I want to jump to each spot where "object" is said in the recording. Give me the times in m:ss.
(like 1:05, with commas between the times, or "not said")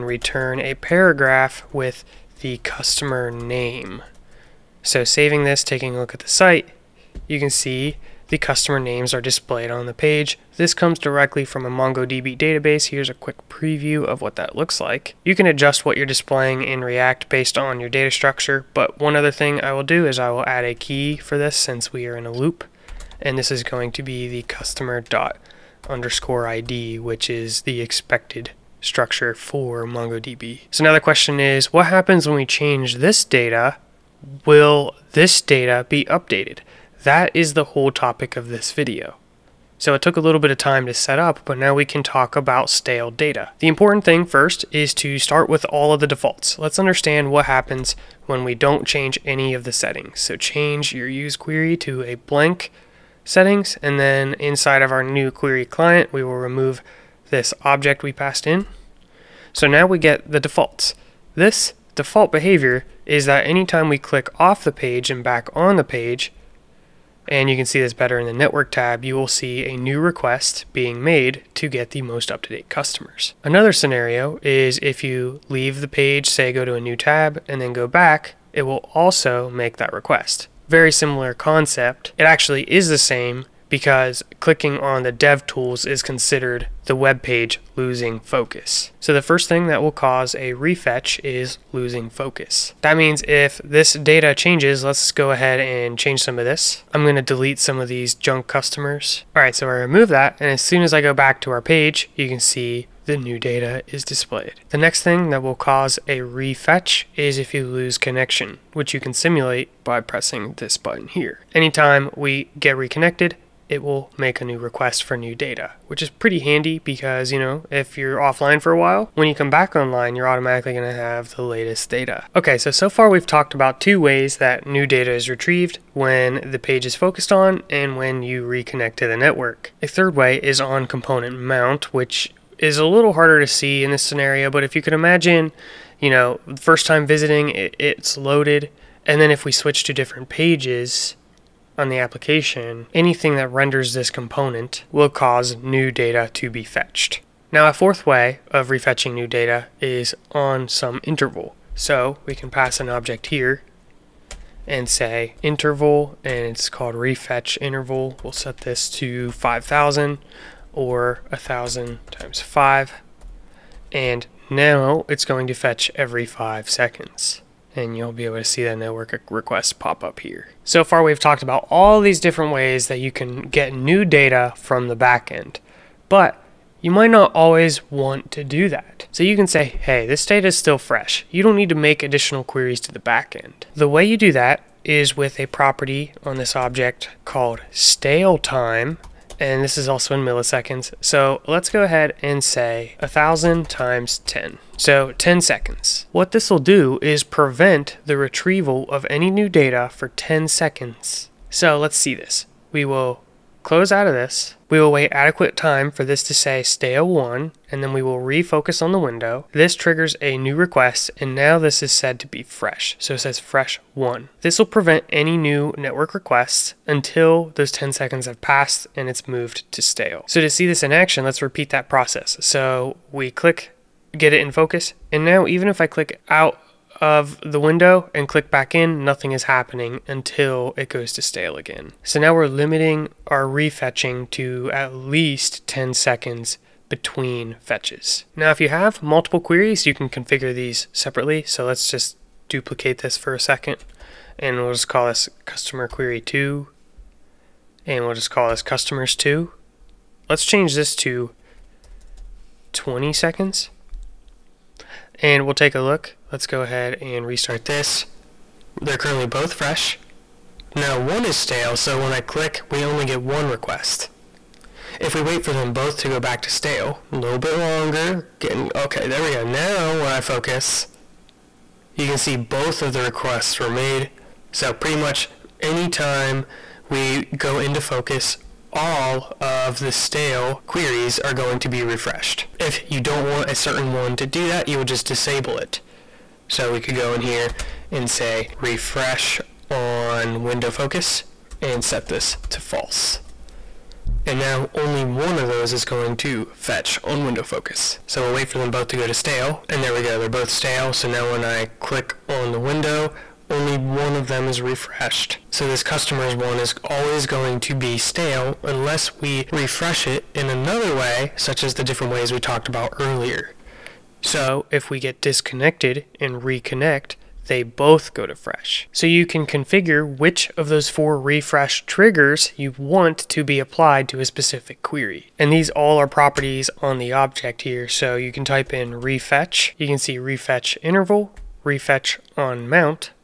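0:57, 2:32, 3:06, 5:27.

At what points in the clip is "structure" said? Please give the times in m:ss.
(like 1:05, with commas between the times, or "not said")
0:18, 0:28.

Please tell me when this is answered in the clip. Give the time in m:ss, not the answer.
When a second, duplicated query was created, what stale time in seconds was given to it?
4:12.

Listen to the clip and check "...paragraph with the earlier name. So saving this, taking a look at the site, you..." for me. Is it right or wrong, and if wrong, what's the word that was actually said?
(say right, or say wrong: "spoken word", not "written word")
wrong: "customer", not "earlier".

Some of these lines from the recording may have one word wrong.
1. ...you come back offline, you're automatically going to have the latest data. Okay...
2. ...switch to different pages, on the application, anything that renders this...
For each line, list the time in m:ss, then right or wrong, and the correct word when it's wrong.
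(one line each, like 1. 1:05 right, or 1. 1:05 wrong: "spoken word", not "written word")
1. 1:59 wrong: "online", not "offline"
2. 2:19 right.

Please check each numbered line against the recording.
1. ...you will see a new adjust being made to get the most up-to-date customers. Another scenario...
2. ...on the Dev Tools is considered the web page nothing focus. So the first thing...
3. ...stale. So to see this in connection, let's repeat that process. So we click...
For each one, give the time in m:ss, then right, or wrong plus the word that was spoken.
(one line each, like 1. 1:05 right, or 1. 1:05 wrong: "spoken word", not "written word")
1. 1:09 wrong: "request", not "adjust"
2. 1:24 wrong: "losing", not "nothing"
3. 3:39 wrong: "action", not "connection".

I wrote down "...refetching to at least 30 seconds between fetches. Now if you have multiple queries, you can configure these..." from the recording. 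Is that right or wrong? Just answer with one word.
wrong.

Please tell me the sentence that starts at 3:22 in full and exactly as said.
We will close out of this.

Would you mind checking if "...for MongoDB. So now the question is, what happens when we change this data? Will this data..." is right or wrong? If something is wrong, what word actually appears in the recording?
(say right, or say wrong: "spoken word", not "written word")
right.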